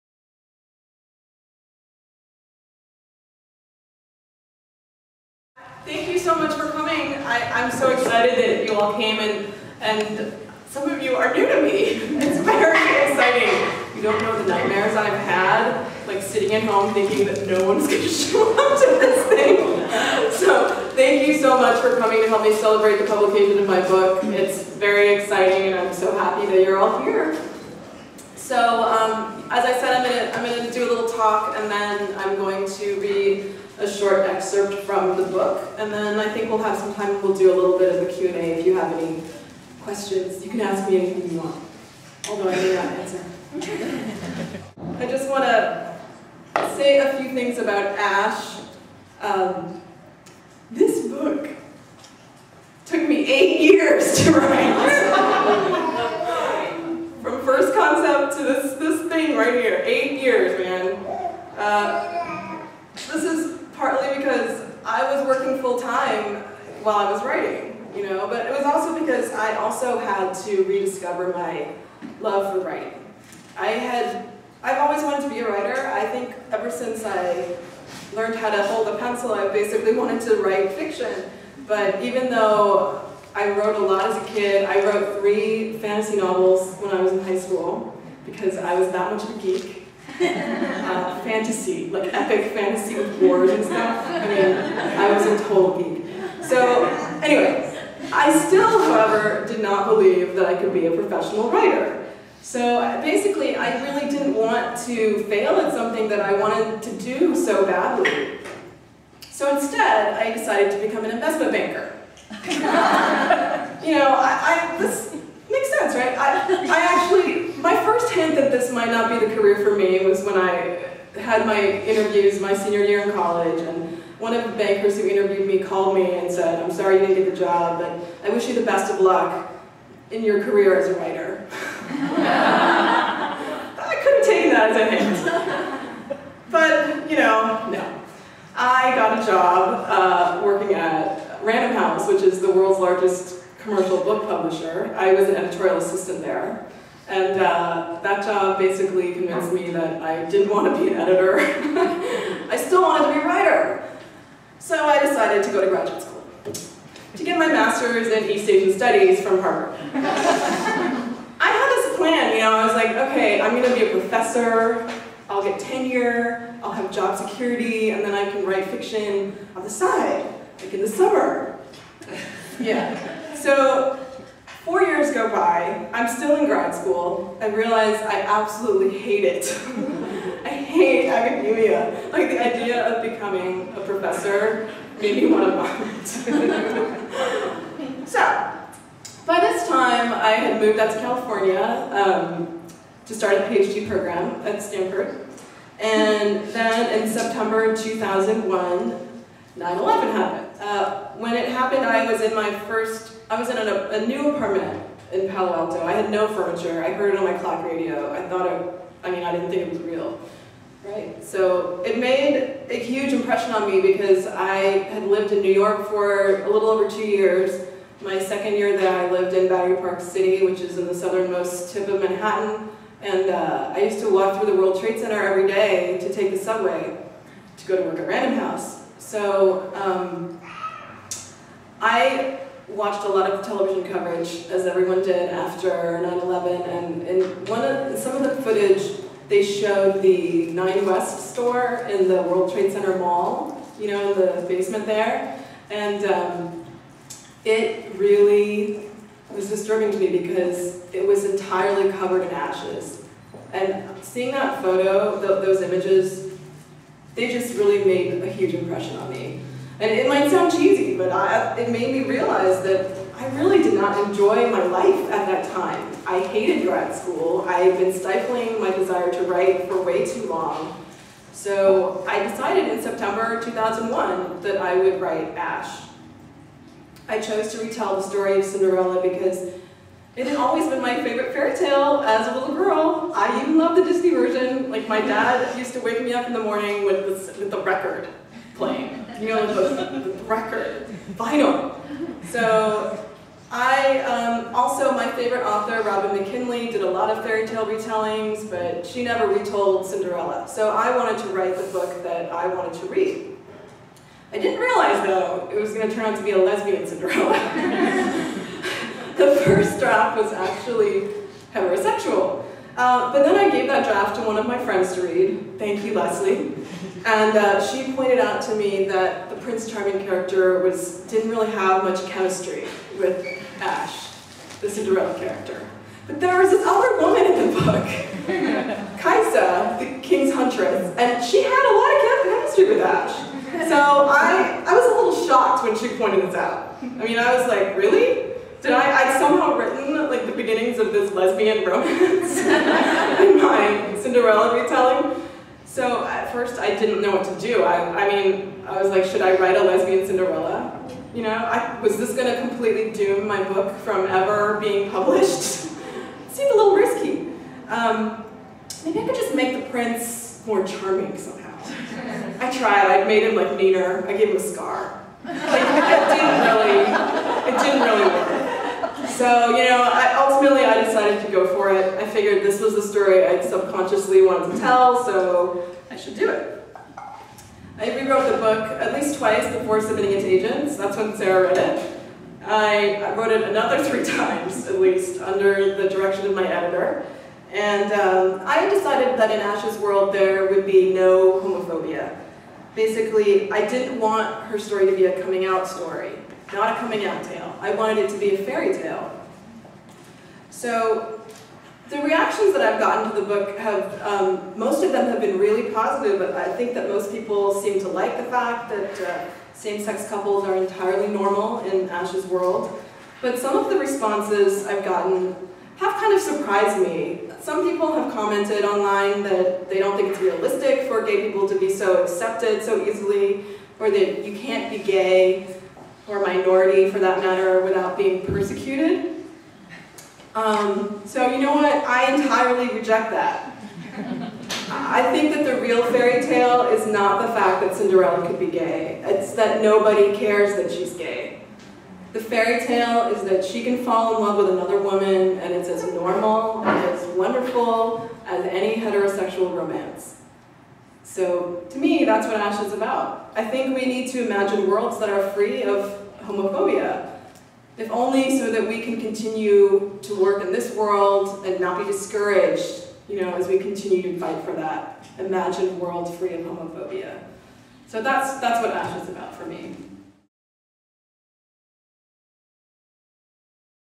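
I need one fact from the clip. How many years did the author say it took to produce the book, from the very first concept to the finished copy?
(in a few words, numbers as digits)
8.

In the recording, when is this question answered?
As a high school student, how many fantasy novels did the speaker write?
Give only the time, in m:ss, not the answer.
1:25.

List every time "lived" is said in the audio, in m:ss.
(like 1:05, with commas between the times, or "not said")
3:35, 3:39.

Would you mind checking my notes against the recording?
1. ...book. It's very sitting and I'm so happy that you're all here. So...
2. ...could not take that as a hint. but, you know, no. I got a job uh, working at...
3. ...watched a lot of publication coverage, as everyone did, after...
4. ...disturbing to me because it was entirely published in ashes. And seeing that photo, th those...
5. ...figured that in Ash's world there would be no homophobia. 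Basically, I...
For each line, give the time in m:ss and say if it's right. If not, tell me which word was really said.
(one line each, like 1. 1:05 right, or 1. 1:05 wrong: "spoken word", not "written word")
1. 0:23 wrong: "exciting", not "sitting"
2. 2:14 right
3. 3:52 wrong: "television", not "publication"
4. 4:09 wrong: "covered", not "published"
5. 6:28 wrong: "decided", not "figured".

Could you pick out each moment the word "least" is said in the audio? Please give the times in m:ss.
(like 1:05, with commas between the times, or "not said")
6:18, 6:24.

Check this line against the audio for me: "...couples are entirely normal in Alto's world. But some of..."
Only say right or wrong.
wrong.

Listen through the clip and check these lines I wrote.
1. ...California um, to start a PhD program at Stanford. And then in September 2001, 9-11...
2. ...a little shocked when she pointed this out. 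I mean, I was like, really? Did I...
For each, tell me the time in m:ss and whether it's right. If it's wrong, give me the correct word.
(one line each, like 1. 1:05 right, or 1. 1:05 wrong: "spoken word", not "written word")
1. 3:10 right
2. 5:34 right.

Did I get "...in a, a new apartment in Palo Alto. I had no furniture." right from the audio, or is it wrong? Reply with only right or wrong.
right.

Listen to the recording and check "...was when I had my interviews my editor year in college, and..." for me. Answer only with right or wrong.
wrong.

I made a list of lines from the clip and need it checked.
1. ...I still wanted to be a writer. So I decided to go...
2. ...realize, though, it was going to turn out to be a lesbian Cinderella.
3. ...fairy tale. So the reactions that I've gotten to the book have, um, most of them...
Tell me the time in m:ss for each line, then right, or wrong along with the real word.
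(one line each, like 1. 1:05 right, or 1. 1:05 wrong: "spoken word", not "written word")
1. 2:32 right
2. 5:04 right
3. 6:38 right.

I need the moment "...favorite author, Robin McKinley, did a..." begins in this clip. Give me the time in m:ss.
4:55.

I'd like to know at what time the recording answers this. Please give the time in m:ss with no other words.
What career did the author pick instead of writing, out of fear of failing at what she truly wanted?
1:51.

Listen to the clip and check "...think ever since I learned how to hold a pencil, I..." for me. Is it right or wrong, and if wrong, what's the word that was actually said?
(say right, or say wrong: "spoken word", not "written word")
right.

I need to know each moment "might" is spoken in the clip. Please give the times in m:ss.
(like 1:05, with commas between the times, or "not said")
1:58, 4:20.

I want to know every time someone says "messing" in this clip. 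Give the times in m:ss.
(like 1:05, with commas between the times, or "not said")
not said.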